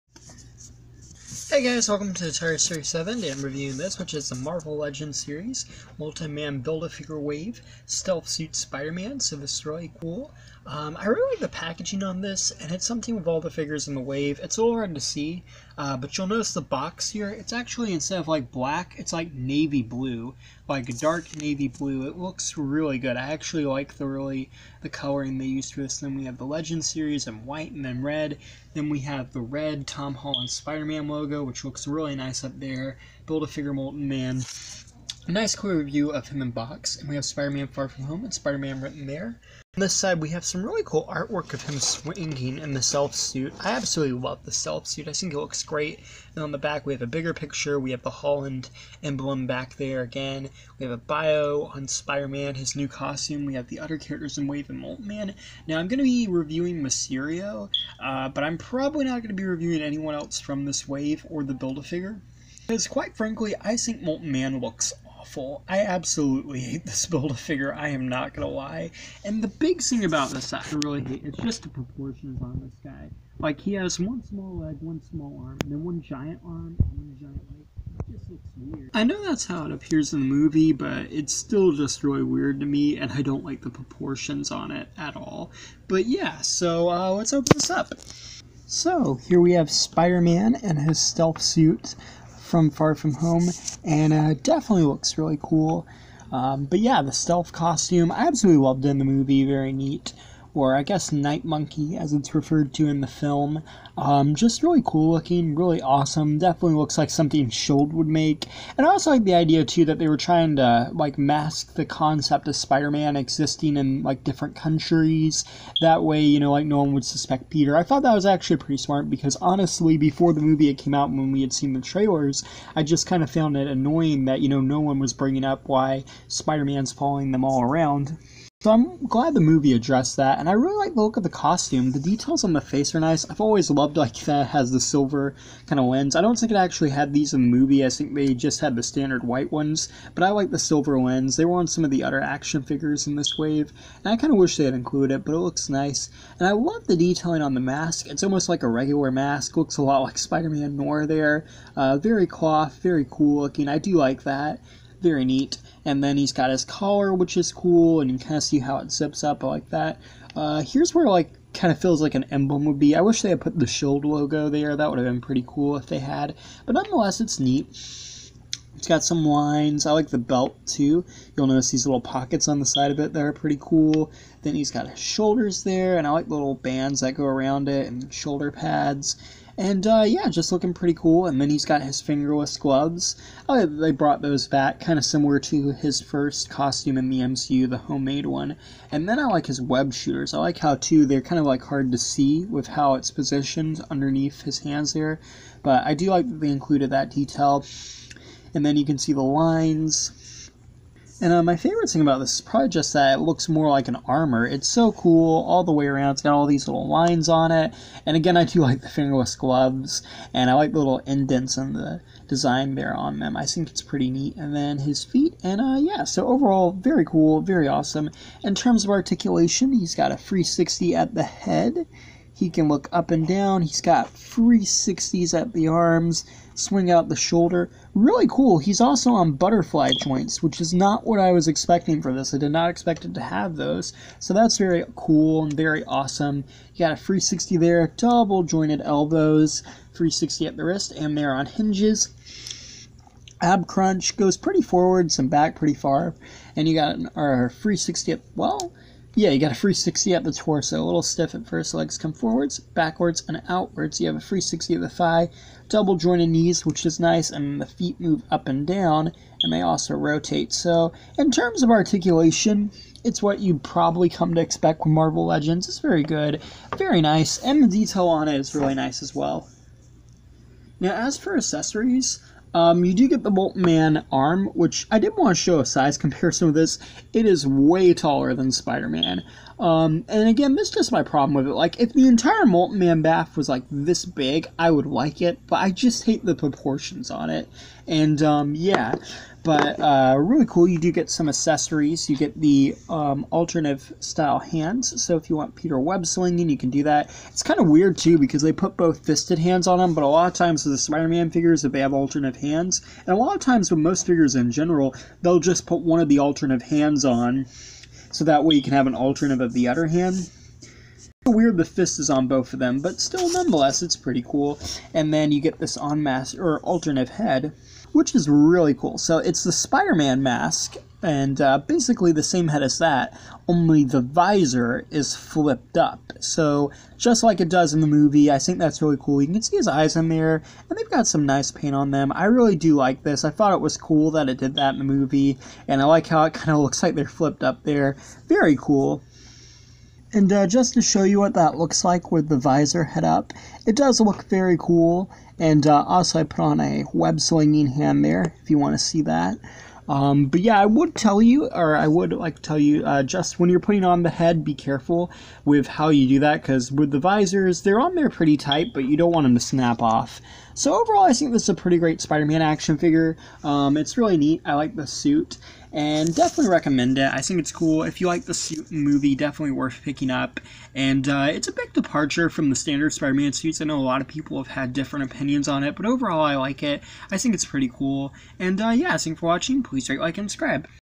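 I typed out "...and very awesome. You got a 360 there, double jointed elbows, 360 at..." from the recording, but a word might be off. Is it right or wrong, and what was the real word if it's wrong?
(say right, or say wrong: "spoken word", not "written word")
right.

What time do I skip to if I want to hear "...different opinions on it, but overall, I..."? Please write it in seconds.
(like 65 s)
374 s.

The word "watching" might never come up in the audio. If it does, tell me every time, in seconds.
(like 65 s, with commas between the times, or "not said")
379 s.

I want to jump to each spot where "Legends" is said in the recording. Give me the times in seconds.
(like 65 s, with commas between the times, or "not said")
4 s, 26 s, 265 s.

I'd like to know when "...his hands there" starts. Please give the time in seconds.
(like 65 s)
194 s.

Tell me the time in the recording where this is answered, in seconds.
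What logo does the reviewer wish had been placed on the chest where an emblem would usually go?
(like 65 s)
163 s.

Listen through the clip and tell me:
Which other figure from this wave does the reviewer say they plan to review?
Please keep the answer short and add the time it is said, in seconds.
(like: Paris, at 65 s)
Mysterio, at 56 s.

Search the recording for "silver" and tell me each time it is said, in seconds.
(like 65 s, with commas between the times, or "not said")
134 s, 140 s.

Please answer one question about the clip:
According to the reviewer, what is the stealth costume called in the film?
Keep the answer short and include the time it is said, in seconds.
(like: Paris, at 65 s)
Night Monkey, at 101 s.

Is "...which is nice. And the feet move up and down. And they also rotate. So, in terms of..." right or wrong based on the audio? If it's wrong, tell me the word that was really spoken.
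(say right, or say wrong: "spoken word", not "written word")
right.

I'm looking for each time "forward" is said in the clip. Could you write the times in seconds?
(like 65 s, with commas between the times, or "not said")
244 s, 252 s.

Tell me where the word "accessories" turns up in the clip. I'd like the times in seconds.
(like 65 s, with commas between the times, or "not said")
271 s, 291 s.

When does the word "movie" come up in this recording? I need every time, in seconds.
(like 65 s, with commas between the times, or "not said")
80 s, 99 s, 120 s, 129 s, 137 s, 327 s, 334 s, 368 s.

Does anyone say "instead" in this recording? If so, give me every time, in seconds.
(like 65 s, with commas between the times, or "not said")
17 s.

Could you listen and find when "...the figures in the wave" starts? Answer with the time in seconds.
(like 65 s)
13 s.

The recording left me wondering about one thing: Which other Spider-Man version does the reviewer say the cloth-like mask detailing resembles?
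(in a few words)
Spider-Man Noir.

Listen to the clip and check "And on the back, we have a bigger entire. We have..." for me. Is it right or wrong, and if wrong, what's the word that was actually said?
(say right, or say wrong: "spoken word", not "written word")
wrong: "picture", not "entire".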